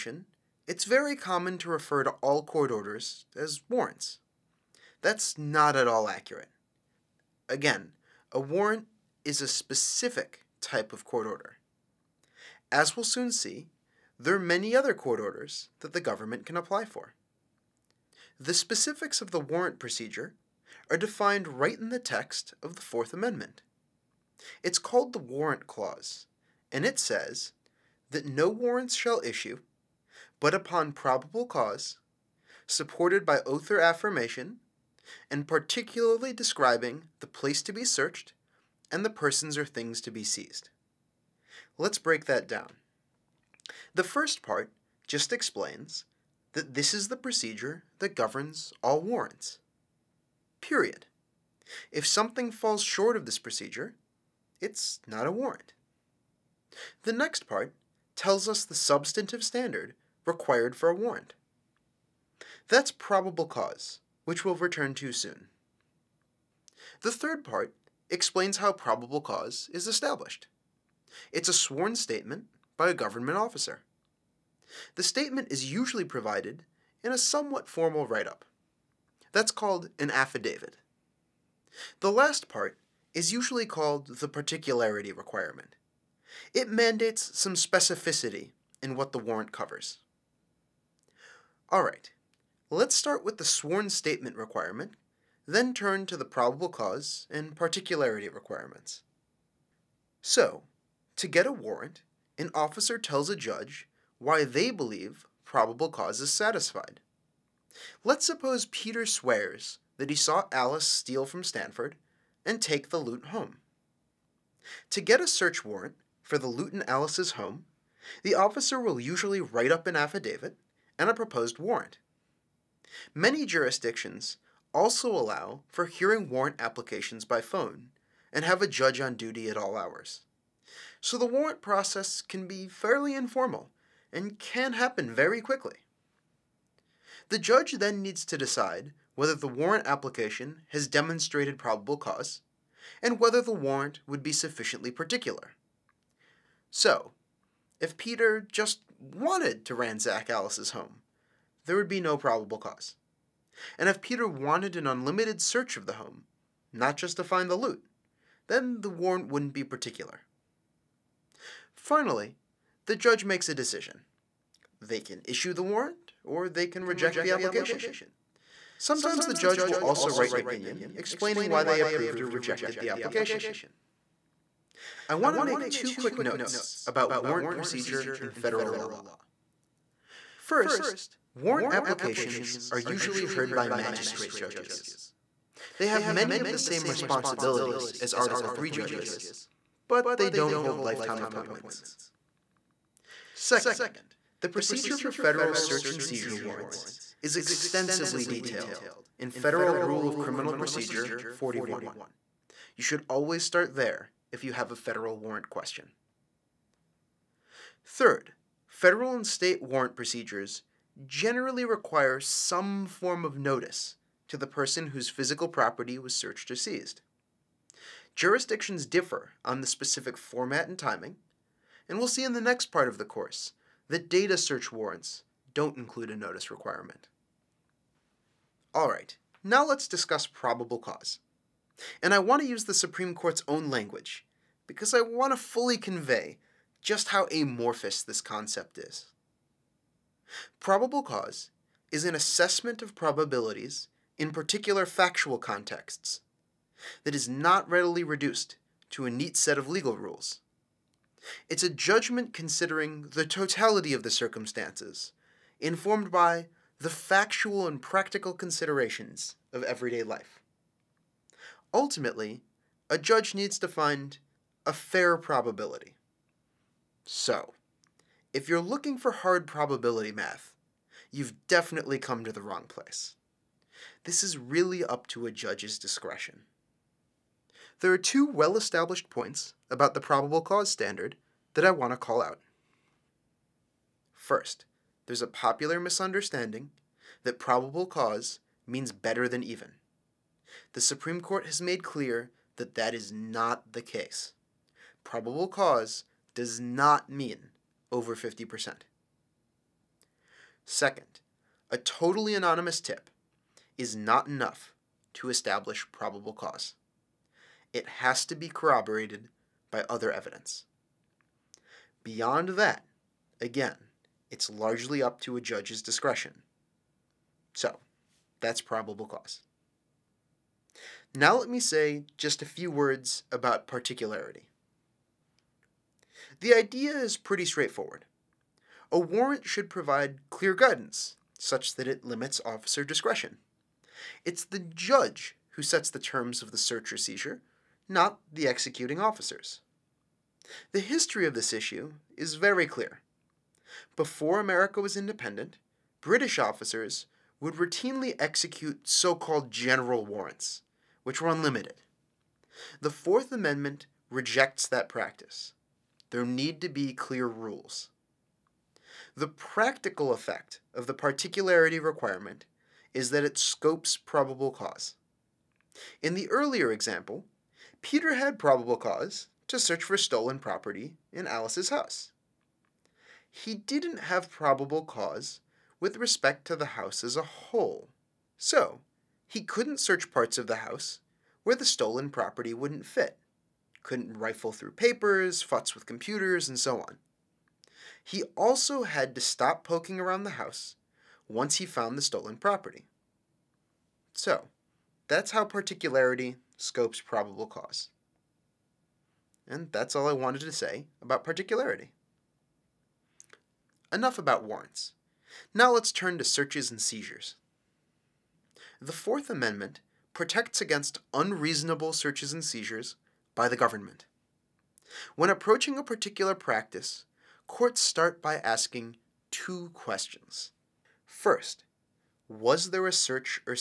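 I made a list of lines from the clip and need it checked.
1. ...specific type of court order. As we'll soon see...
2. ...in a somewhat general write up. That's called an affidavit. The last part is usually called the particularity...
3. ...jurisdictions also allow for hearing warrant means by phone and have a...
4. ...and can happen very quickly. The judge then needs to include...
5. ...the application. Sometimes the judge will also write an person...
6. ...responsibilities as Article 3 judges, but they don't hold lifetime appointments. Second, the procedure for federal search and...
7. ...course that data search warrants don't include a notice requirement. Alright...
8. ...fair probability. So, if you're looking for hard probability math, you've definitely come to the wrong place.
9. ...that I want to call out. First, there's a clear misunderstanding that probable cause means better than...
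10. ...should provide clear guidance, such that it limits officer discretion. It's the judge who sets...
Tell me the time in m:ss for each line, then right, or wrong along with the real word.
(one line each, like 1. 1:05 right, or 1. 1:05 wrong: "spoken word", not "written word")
1. 0:09 right
2. 1:17 wrong: "formal", not "general"
3. 2:03 wrong: "applications", not "means"
4. 2:14 wrong: "decide", not "include"
5. 2:47 wrong: "opinion", not "person"
6. 3:06 right
7. 3:43 right
8. 4:24 right
9. 4:41 wrong: "popular", not "clear"
10. 5:29 right.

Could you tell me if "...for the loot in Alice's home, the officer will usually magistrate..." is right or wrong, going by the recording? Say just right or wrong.
wrong.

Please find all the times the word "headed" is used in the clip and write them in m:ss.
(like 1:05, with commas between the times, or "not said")
not said.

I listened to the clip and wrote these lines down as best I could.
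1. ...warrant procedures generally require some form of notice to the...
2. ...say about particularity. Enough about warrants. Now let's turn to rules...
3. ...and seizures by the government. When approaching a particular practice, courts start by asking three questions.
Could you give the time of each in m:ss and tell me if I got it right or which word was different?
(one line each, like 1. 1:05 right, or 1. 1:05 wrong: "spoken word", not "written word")
1. 3:29 right
2. 6:40 wrong: "searches", not "rules"
3. 6:52 wrong: "two", not "three".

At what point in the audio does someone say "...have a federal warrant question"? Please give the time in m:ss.
3:24.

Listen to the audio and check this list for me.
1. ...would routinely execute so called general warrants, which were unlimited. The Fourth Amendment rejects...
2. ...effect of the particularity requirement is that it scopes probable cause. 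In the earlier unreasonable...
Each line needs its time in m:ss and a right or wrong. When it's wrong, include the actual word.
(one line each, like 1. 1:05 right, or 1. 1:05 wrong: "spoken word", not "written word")
1. 5:47 right
2. 6:00 wrong: "example", not "unreasonable".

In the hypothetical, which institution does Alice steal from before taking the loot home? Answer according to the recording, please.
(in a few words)
Stanford.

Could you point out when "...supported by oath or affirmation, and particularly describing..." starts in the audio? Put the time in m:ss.
0:32.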